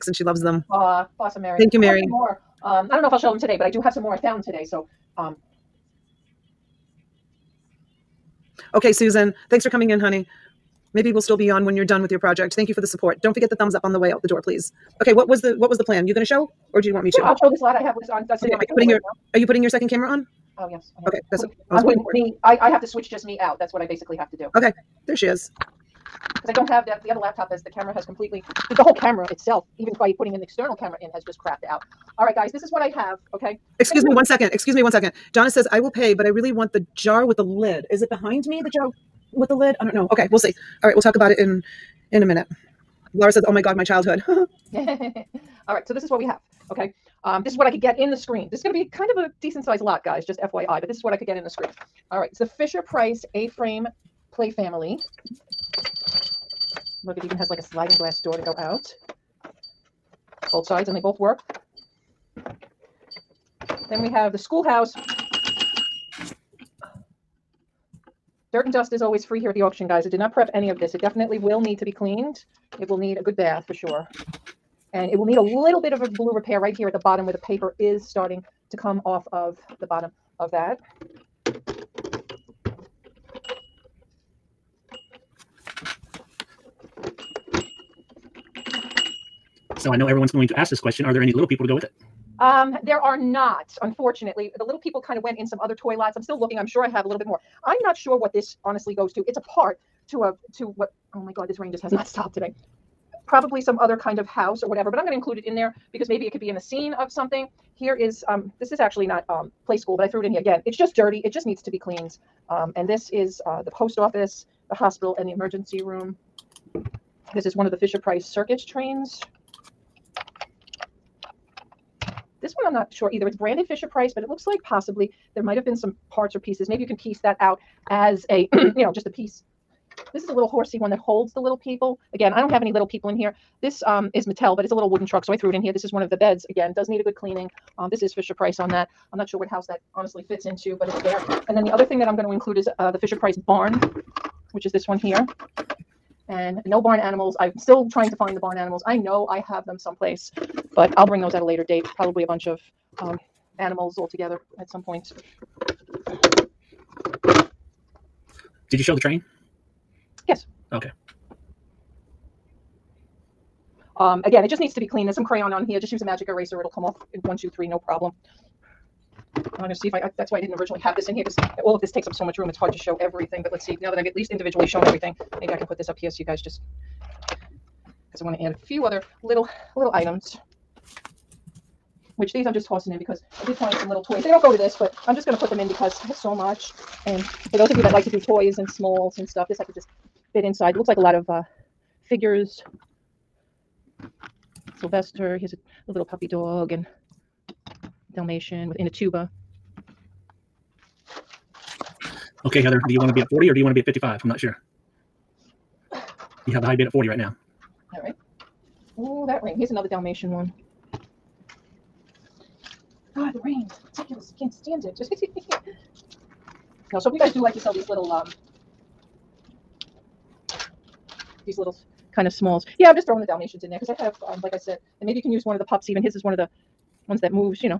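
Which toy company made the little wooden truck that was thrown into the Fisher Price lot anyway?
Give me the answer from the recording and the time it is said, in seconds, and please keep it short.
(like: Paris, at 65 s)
Mattel, at 134 s.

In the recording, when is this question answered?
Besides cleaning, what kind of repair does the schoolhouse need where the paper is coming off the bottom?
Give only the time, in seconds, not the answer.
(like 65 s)
76 s.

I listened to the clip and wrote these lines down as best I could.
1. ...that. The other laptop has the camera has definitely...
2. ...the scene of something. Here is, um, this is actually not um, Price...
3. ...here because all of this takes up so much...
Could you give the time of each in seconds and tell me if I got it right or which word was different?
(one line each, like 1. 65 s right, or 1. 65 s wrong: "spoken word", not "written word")
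1. 26 s wrong: "completely", not "definitely"
2. 106 s wrong: "Playskool", not "Price"
3. 171 s right.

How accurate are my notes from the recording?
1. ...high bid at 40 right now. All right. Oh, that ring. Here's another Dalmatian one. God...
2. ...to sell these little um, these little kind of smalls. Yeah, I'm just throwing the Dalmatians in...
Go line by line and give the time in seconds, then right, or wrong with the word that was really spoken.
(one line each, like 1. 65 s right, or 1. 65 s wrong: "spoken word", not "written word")
1. 206 s right
2. 217 s right.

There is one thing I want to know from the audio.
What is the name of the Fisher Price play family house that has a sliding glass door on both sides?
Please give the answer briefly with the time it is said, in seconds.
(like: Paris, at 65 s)
A frame, at 53 s.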